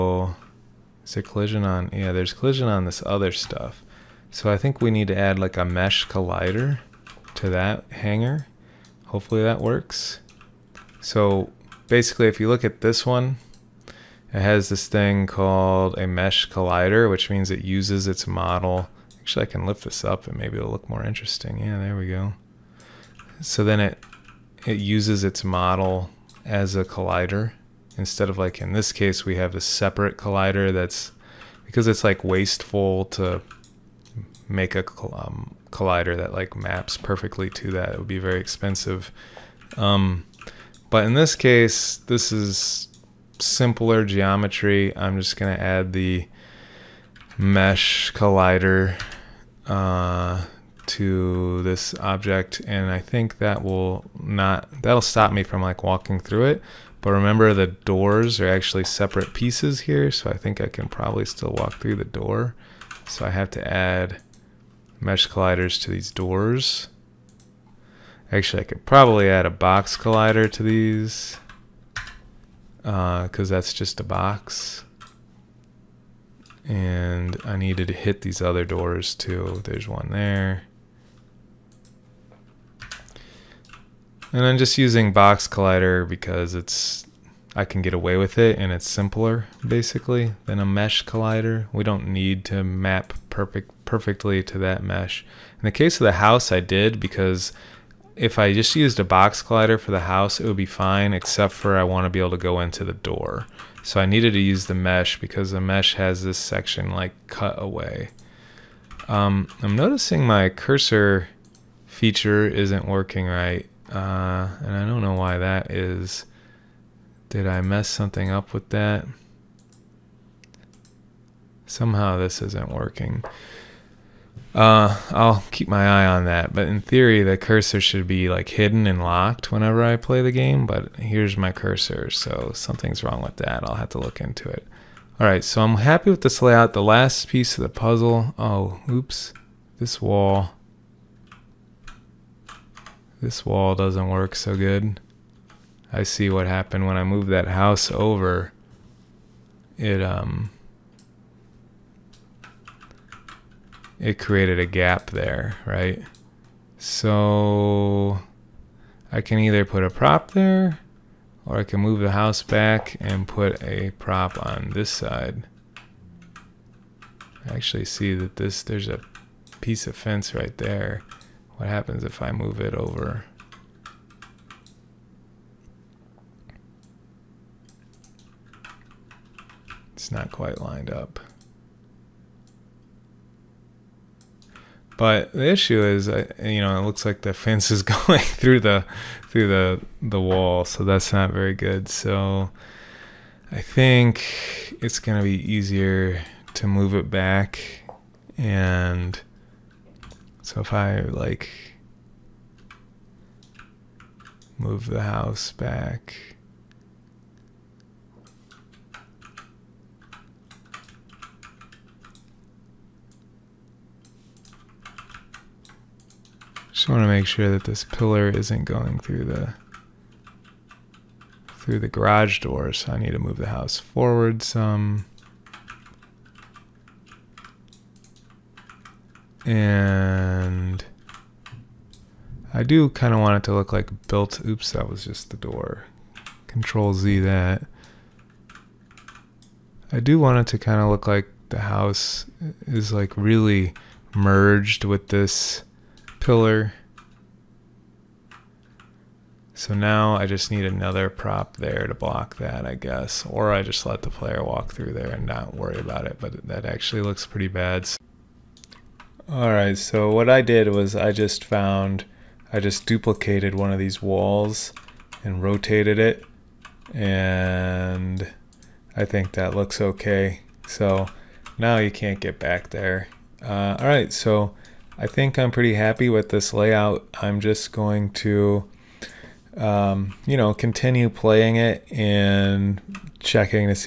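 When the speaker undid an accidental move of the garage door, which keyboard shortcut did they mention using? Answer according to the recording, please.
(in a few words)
Control Z.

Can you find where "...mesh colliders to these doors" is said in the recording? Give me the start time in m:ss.
1:05.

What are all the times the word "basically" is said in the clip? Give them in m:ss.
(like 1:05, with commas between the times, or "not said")
0:11, 1:29.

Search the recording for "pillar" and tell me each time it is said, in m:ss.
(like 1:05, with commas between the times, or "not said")
3:37, 4:06.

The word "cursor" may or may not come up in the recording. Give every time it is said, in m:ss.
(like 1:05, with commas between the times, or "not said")
1:50, 2:07, 2:11.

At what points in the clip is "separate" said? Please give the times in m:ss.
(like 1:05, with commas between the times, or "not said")
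0:29, 0:58.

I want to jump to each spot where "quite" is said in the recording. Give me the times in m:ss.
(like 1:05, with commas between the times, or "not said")
3:00.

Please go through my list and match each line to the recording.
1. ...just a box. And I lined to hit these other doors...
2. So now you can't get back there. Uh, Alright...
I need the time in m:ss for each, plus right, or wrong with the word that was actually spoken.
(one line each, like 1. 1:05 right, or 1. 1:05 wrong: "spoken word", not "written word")
1. 1:13 wrong: "needed", not "lined"
2. 4:30 right.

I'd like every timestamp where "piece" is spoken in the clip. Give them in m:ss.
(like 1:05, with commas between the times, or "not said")
0:59, 2:17, 2:49.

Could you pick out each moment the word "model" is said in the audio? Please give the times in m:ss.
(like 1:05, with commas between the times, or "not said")
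0:18, 0:25.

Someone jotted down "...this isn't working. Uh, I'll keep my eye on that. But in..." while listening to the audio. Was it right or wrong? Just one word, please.
right.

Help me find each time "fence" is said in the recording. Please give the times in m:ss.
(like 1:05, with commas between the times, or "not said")
2:49, 3:07.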